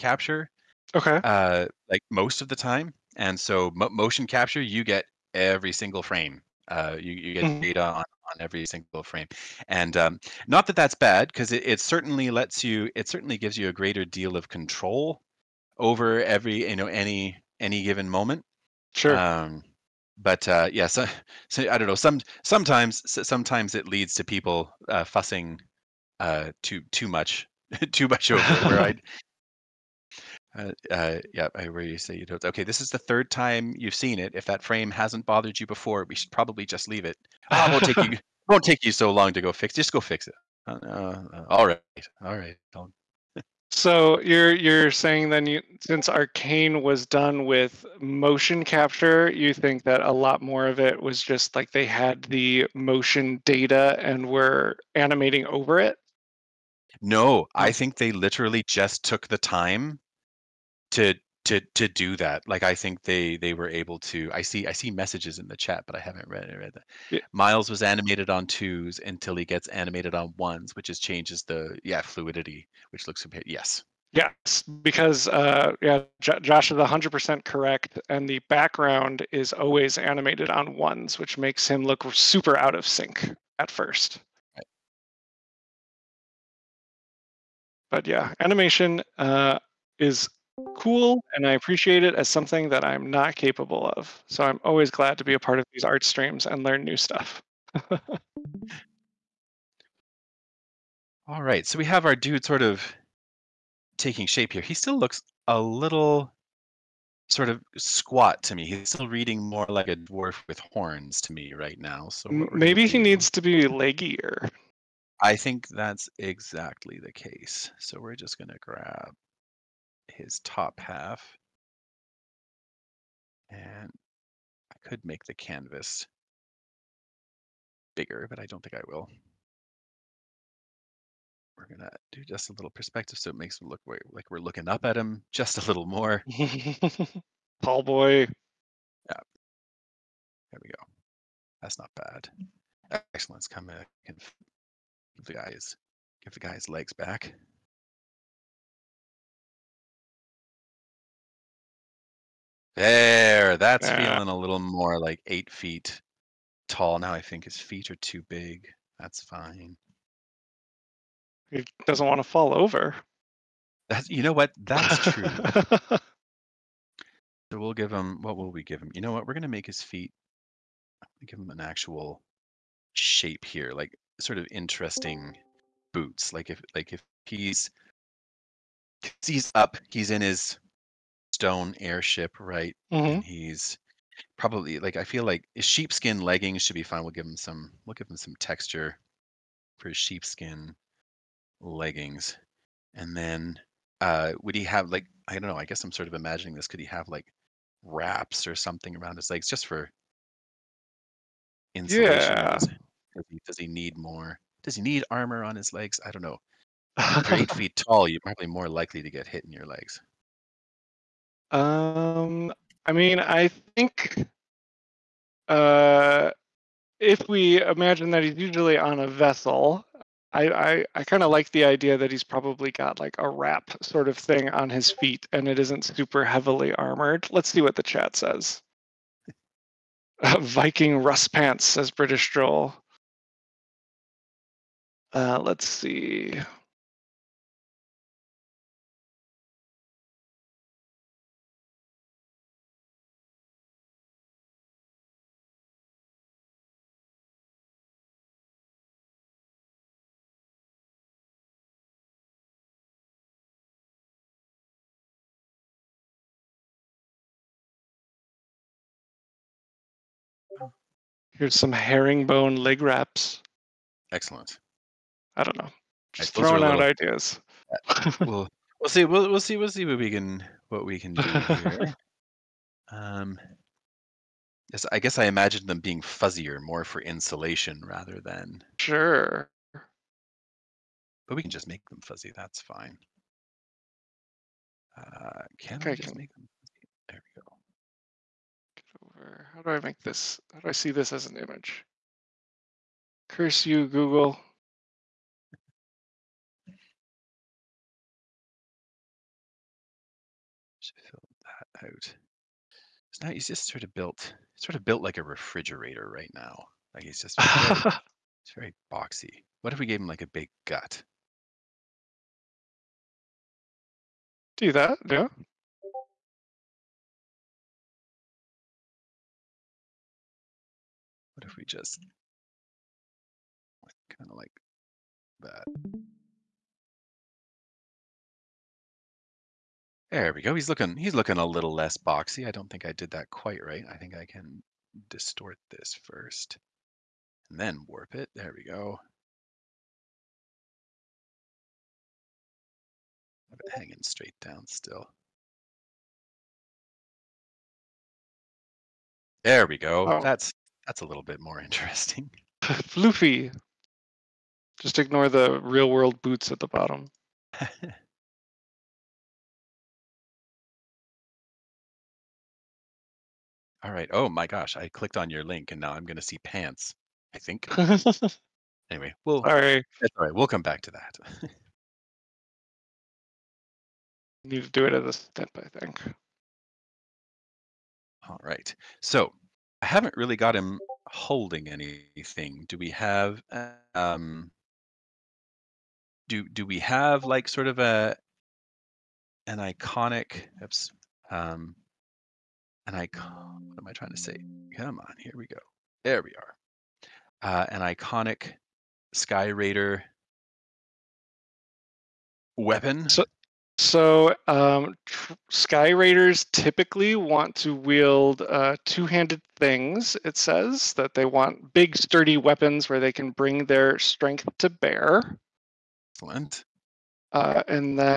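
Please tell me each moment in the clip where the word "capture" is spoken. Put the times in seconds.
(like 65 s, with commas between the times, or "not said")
4 s, 48 s.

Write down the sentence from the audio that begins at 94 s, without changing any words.
So I'm always glad to be a part of these art streams and learn new stuff.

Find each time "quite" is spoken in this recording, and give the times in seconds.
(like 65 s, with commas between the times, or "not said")
333 s.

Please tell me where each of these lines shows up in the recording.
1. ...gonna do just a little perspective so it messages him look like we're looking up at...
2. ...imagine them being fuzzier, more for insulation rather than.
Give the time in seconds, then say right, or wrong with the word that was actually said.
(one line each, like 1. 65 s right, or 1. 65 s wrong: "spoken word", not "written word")
1. 131 s wrong: "makes", not "messages"
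2. 275 s right.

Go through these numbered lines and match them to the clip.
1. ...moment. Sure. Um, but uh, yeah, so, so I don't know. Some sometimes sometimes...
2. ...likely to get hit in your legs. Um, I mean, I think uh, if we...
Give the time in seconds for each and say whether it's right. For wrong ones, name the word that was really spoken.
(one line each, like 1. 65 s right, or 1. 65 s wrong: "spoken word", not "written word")
1. 18 s right
2. 208 s right.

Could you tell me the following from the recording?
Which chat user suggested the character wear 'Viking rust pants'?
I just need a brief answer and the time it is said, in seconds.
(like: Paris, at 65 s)
British Joel, at 231 s.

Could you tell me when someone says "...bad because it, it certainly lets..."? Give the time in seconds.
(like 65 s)
10 s.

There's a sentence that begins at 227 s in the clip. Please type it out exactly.
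Let's see what the chat says.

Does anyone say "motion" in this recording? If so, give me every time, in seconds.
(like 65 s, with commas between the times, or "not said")
3 s, 48 s, 52 s.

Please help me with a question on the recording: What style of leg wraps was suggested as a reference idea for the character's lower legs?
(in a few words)
Herringbone.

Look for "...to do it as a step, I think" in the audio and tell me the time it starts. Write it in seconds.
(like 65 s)
374 s.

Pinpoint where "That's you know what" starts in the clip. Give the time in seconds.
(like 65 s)
163 s.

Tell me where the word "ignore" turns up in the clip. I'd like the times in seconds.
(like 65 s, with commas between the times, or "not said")
354 s.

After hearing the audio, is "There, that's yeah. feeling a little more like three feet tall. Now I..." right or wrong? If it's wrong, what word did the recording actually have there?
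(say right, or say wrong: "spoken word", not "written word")
wrong: "eight", not "three".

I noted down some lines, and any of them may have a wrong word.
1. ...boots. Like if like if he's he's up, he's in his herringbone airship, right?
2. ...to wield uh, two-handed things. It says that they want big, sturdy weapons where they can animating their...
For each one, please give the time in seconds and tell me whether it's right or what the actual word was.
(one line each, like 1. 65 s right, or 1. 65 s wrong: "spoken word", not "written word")
1. 175 s wrong: "stone", not "herringbone"
2. 407 s wrong: "bring", not "animating".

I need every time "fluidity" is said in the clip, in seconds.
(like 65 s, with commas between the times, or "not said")
72 s.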